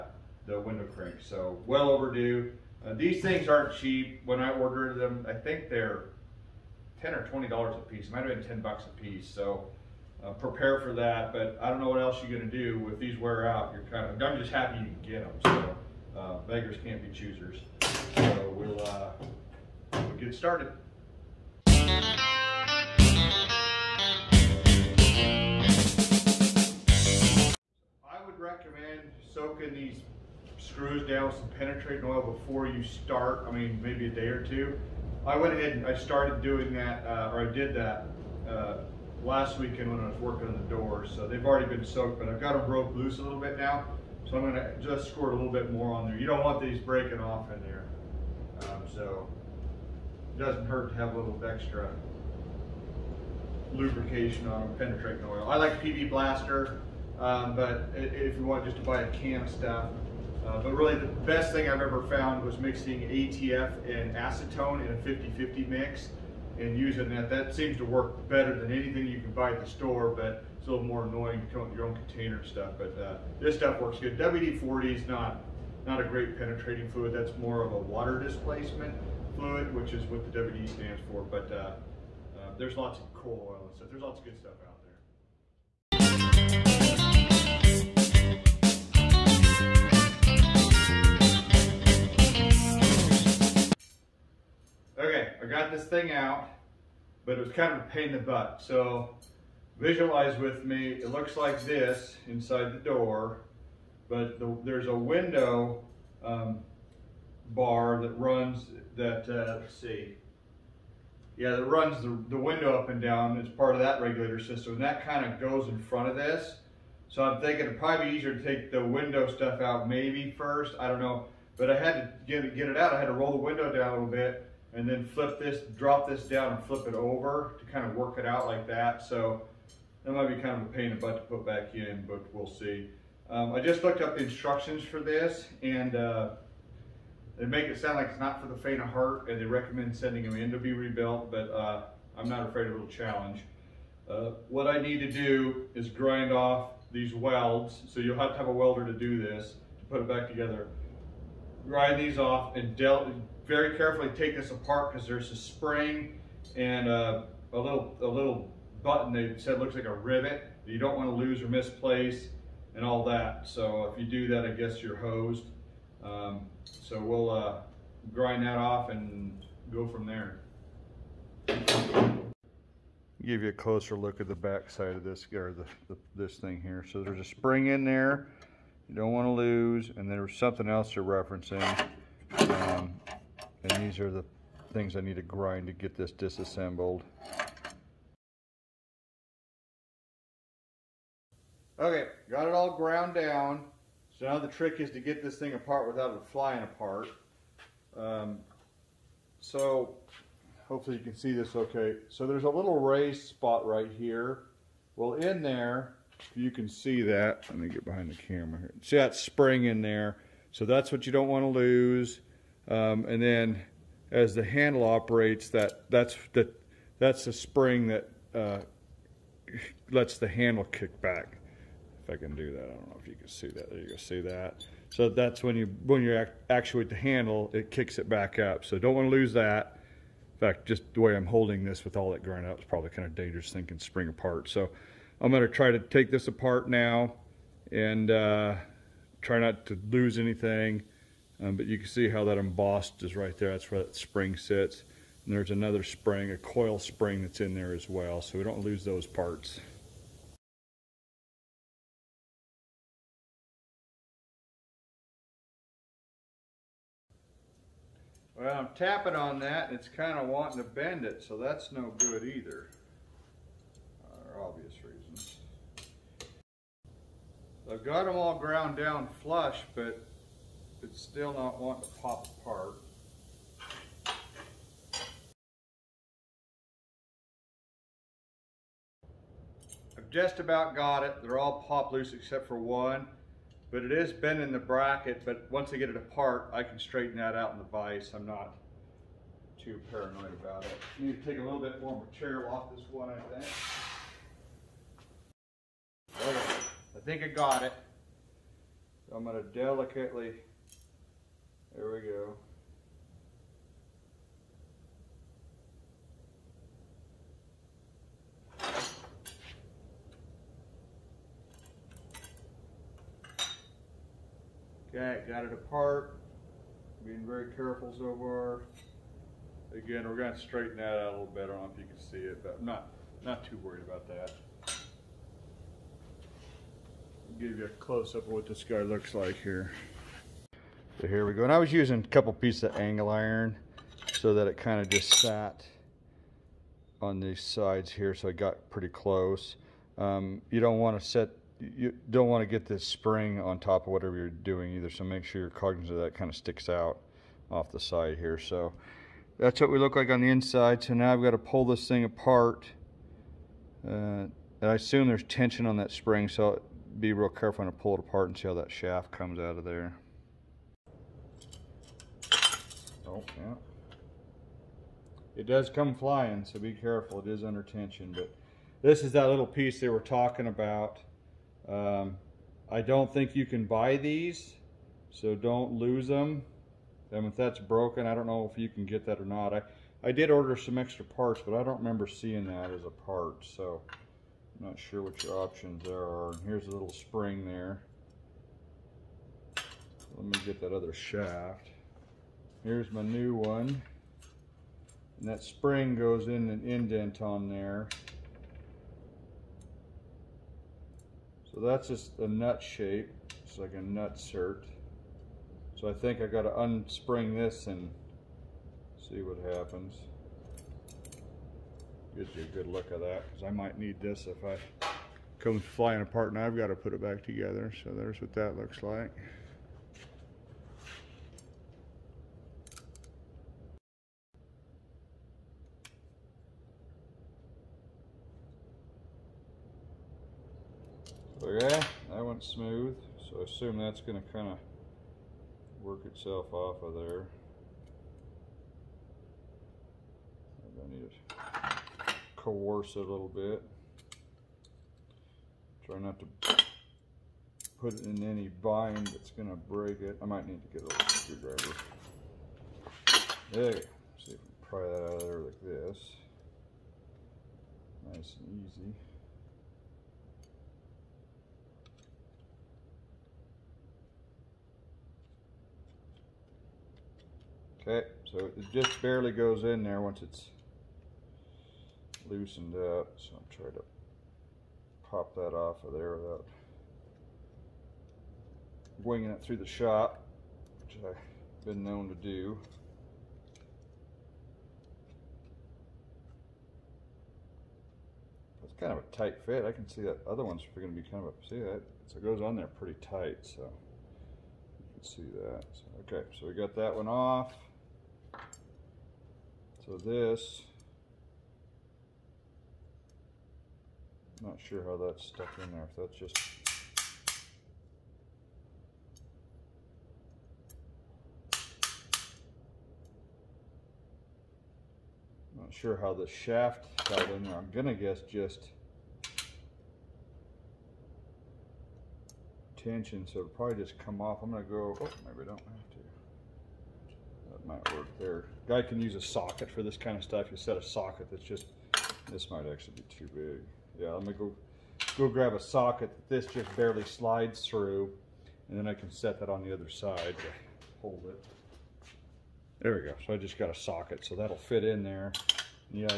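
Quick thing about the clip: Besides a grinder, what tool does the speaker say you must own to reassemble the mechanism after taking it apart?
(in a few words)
a welder.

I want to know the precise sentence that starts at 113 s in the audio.
It's part of that regulator system.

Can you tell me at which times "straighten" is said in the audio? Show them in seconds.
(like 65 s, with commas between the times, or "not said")
286 s, 320 s.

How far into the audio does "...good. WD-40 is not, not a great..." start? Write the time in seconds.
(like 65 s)
73 s.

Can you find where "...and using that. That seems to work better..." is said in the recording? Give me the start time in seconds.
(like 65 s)
66 s.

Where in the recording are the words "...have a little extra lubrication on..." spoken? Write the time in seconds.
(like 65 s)
50 s.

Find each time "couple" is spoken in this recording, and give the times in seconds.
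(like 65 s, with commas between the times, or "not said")
332 s.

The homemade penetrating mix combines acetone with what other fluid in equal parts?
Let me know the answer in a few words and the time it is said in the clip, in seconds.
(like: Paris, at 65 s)
ATF, at 63 s.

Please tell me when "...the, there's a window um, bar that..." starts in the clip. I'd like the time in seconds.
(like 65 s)
104 s.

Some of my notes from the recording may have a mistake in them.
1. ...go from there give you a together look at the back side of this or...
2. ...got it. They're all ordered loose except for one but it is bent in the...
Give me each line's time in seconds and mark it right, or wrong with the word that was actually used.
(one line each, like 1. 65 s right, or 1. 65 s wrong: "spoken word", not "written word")
1. 169 s wrong: "closer", not "together"
2. 280 s wrong: "popped", not "ordered".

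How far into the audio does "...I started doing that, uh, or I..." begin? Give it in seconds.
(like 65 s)
35 s.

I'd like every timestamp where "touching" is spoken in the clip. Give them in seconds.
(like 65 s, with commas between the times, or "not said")
not said.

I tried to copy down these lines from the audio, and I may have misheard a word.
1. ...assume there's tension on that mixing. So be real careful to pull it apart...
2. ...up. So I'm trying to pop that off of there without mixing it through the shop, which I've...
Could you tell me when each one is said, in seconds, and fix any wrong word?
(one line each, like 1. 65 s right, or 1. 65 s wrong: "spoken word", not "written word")
1. 354 s wrong: "spring", not "mixing"
2. 472 s wrong: "winging", not "mixing".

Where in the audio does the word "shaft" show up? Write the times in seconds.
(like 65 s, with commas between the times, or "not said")
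358 s, 390 s, 516 s.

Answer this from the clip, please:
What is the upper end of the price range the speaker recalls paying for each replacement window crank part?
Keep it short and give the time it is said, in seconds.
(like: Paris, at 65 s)
20 dollars, at 7 s.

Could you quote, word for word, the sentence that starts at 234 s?
So I'm going to try to take this apart now and uh, try not to lose anything.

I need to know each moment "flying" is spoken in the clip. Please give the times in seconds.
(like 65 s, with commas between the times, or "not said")
196 s, 365 s, 415 s.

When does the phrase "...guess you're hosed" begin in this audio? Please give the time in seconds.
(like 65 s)
164 s.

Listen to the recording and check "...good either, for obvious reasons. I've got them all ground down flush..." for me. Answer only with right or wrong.
right.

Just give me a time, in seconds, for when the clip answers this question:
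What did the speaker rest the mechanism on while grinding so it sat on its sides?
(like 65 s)
332 s.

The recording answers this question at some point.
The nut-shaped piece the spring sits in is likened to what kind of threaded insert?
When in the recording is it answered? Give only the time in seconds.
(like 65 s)
403 s.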